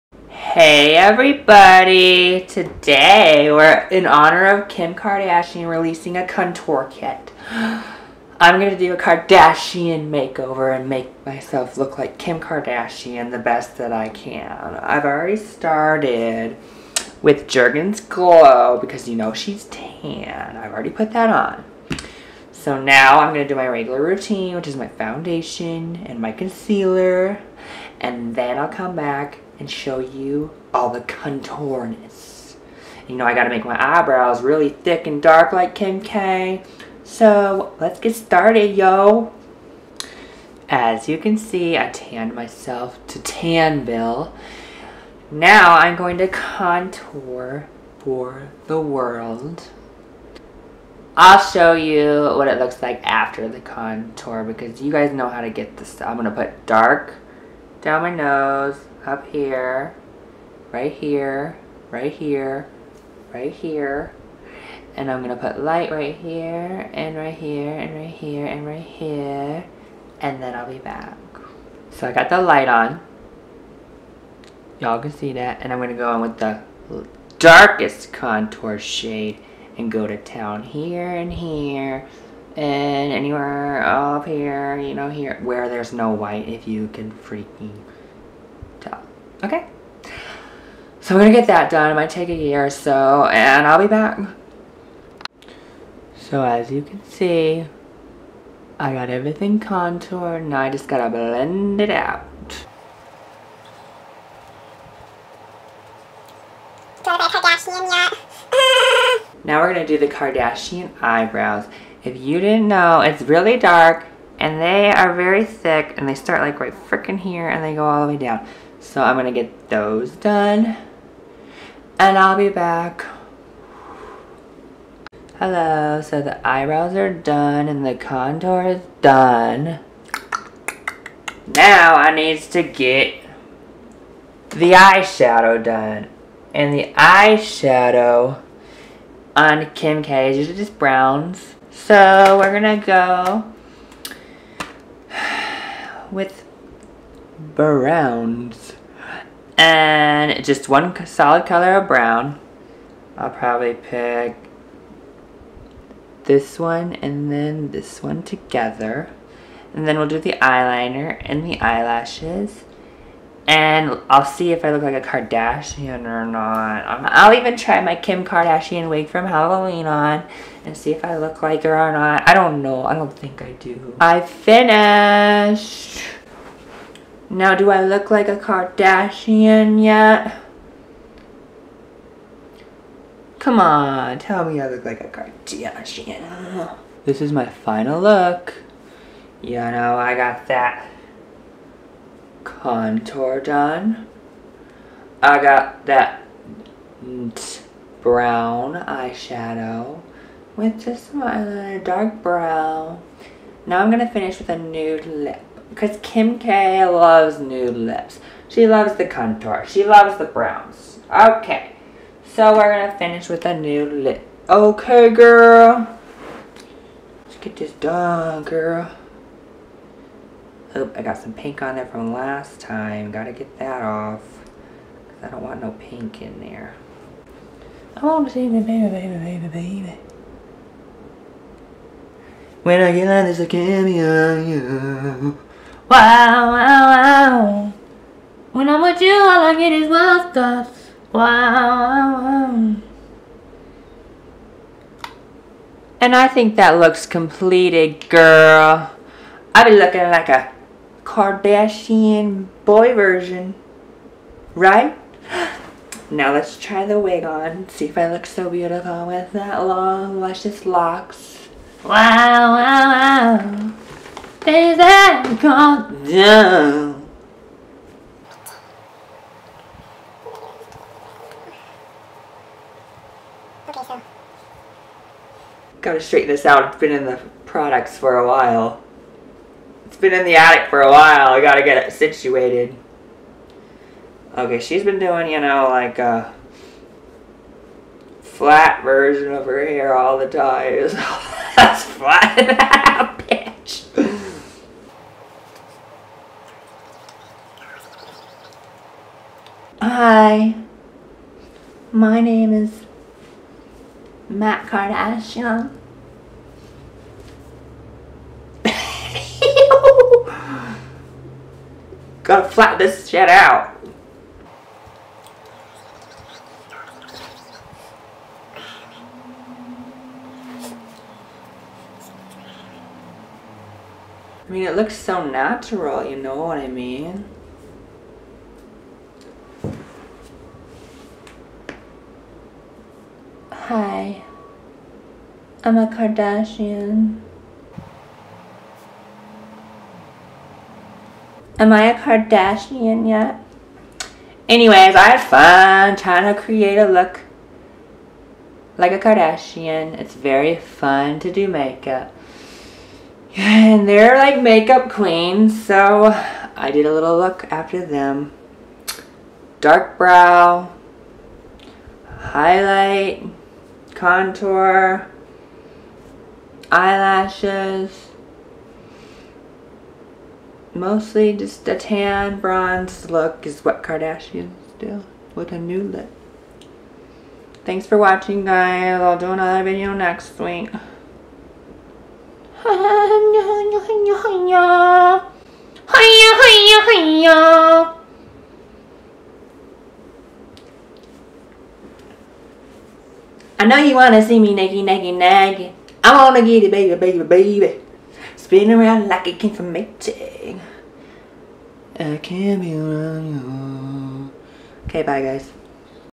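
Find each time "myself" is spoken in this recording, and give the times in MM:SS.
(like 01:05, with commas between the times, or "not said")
00:11, 00:42.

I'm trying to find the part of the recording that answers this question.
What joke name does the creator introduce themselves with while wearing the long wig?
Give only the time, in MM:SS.
05:04.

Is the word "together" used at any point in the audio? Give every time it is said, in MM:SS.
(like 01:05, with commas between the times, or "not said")
02:38.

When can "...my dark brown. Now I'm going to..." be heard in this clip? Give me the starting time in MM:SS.
03:21.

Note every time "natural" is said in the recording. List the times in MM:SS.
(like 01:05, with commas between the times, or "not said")
05:25.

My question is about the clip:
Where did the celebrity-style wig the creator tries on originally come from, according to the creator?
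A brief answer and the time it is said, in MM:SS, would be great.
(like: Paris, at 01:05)
Halloween, at 02:49.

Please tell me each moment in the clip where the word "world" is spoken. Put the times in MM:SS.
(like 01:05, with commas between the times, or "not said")
00:48.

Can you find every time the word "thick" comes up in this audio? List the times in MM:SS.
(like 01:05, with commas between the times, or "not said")
00:34, 01:55.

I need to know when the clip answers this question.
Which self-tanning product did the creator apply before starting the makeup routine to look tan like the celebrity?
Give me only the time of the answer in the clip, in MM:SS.
00:17.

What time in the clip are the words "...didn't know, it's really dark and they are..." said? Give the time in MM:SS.
01:52.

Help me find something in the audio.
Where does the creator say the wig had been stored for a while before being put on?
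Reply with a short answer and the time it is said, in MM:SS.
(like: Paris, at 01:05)
The attic, at 04:40.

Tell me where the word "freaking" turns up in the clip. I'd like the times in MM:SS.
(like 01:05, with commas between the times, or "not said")
01:27, 01:56.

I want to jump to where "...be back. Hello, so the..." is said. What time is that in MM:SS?
02:02.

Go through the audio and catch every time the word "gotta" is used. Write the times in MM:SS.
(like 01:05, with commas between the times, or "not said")
00:33, 01:40, 03:43, 04:35, 04:41.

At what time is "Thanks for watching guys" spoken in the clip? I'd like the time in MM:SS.
06:17.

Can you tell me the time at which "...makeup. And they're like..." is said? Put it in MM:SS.
05:51.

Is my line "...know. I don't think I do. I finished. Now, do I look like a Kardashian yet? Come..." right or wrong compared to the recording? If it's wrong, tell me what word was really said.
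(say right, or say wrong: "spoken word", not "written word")
right.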